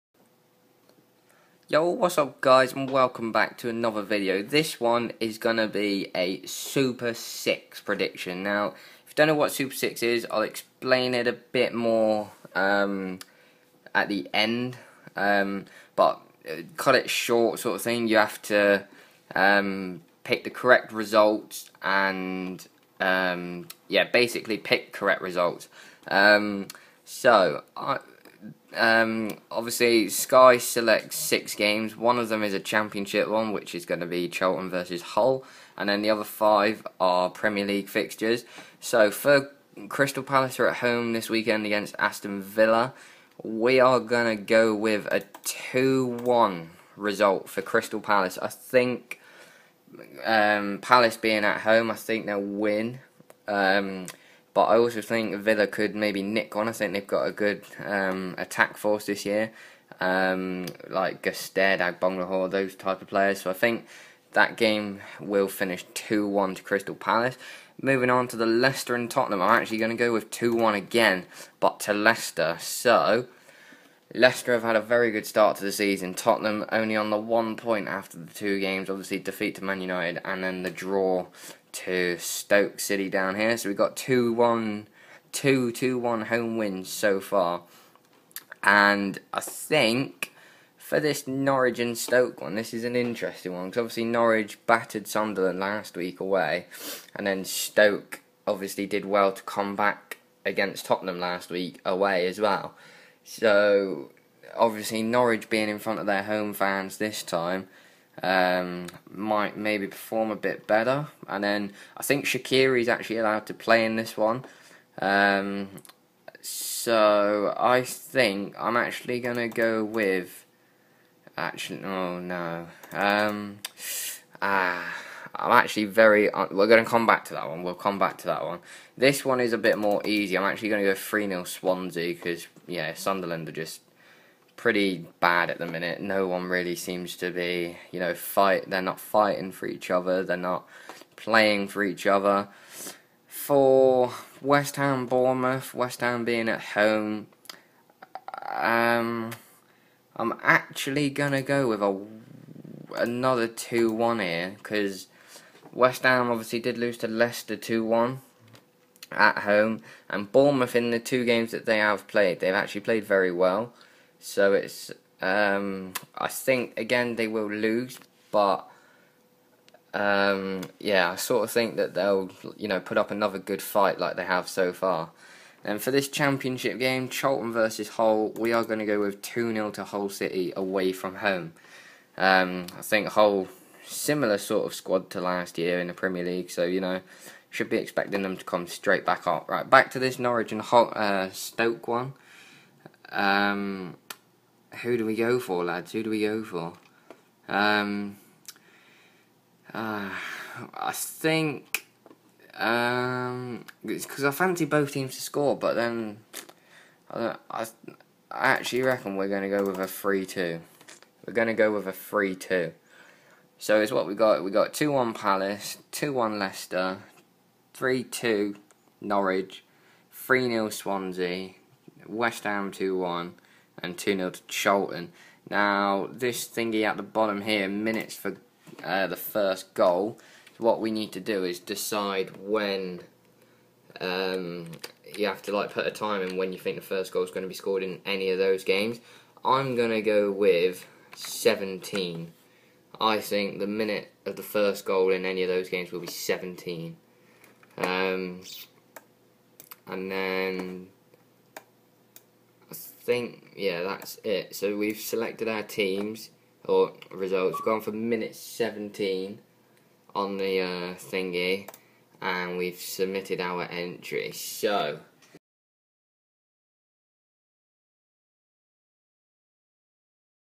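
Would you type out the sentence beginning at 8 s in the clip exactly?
Now, if you don't know what Super 6 is, I'll explain it a bit more um, at the end.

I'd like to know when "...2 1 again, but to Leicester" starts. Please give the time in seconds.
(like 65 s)
70 s.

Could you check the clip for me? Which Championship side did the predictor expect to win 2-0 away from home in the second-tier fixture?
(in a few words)
Hull City.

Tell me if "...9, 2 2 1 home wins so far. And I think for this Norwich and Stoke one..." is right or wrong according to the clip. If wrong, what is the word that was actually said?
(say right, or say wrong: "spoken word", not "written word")
wrong: "1", not "9".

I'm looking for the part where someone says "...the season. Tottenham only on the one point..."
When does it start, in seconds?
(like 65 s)
75 s.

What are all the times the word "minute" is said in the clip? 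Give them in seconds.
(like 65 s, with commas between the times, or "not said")
135 s, 227 s, 243 s, 257 s.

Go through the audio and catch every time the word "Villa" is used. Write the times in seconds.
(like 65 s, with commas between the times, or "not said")
42 s, 55 s.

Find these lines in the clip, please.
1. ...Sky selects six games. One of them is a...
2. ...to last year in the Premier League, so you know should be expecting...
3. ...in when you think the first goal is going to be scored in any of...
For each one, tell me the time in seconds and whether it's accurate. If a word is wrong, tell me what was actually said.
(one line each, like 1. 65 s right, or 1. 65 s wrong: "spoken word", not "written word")
1. 30 s right
2. 185 s right
3. 236 s right.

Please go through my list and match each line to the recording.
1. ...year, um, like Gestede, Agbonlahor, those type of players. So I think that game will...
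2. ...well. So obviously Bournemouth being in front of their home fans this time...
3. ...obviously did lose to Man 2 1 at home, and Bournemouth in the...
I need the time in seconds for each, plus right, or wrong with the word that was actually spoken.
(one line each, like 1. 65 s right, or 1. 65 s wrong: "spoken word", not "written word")
1. 59 s right
2. 102 s wrong: "Norwich", not "Bournemouth"
3. 156 s wrong: "Leicester", not "Man".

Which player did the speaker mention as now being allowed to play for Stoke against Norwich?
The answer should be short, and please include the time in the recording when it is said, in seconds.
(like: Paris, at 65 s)
Shaqiri, at 112 s.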